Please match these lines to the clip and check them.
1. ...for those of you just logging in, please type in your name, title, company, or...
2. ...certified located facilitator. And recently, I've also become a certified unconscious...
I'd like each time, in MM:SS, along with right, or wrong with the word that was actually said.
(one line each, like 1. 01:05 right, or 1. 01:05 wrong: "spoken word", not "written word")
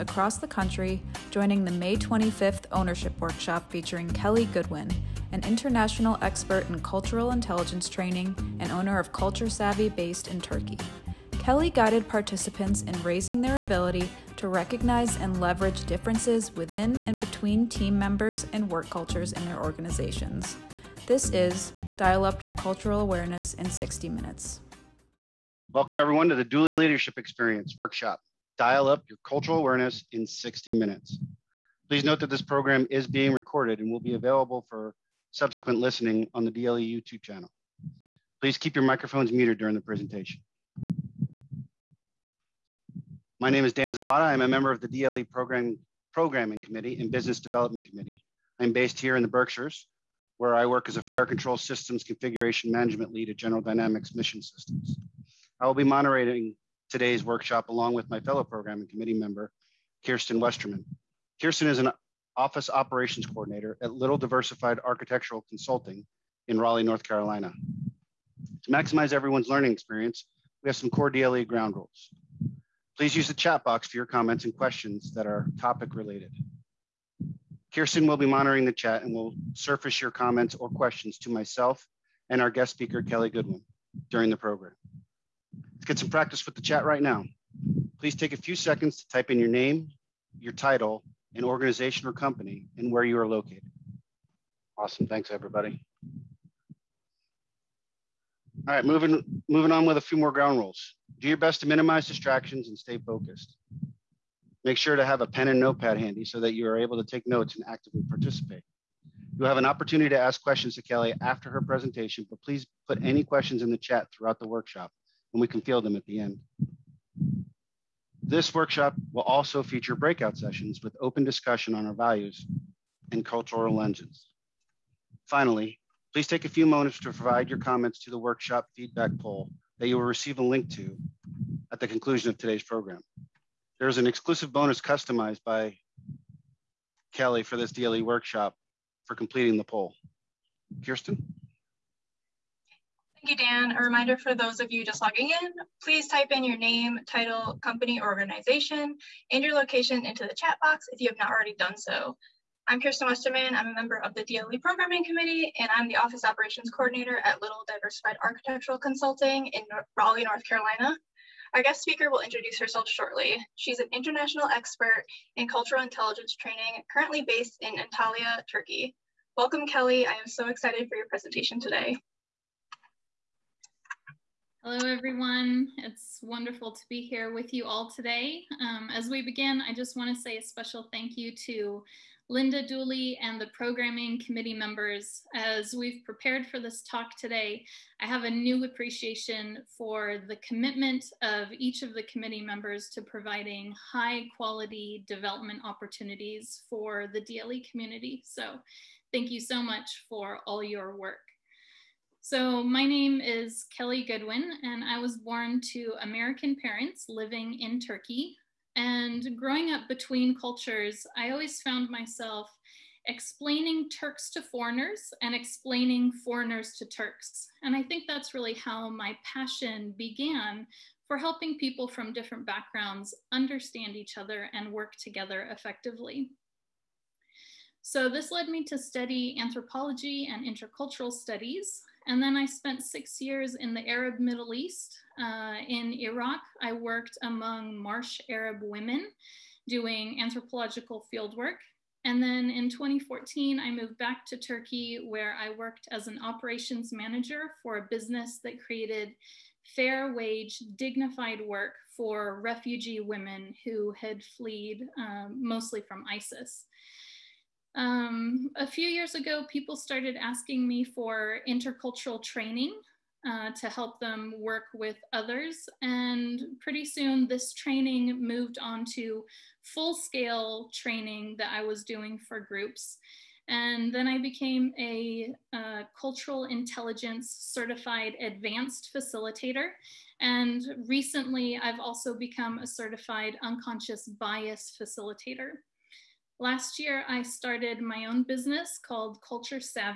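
1. 02:24 right
2. 04:37 wrong: "advanced", not "located".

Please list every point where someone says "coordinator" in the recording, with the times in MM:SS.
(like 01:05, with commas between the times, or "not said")
01:03, 02:36.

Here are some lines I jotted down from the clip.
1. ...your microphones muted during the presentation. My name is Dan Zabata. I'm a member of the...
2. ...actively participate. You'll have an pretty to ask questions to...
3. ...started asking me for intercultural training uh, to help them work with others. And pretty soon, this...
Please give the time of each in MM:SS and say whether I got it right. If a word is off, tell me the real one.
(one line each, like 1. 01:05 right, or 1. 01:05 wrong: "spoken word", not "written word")
1. 00:38 right
2. 01:47 wrong: "opportunity", not "pretty"
3. 04:19 right.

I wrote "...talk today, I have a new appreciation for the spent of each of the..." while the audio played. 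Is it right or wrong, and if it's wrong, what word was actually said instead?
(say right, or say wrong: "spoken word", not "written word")
wrong: "commitment", not "spent".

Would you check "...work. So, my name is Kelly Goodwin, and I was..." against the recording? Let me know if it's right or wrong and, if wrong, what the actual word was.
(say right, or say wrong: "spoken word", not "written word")
right.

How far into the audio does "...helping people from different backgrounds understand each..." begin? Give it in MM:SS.
03:41.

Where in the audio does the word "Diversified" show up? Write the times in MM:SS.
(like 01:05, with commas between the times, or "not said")
01:04, 02:37.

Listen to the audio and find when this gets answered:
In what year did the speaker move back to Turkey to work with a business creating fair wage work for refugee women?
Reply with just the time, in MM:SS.
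04:02.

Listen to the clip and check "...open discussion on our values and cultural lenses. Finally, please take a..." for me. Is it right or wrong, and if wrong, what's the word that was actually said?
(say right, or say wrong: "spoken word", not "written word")
right.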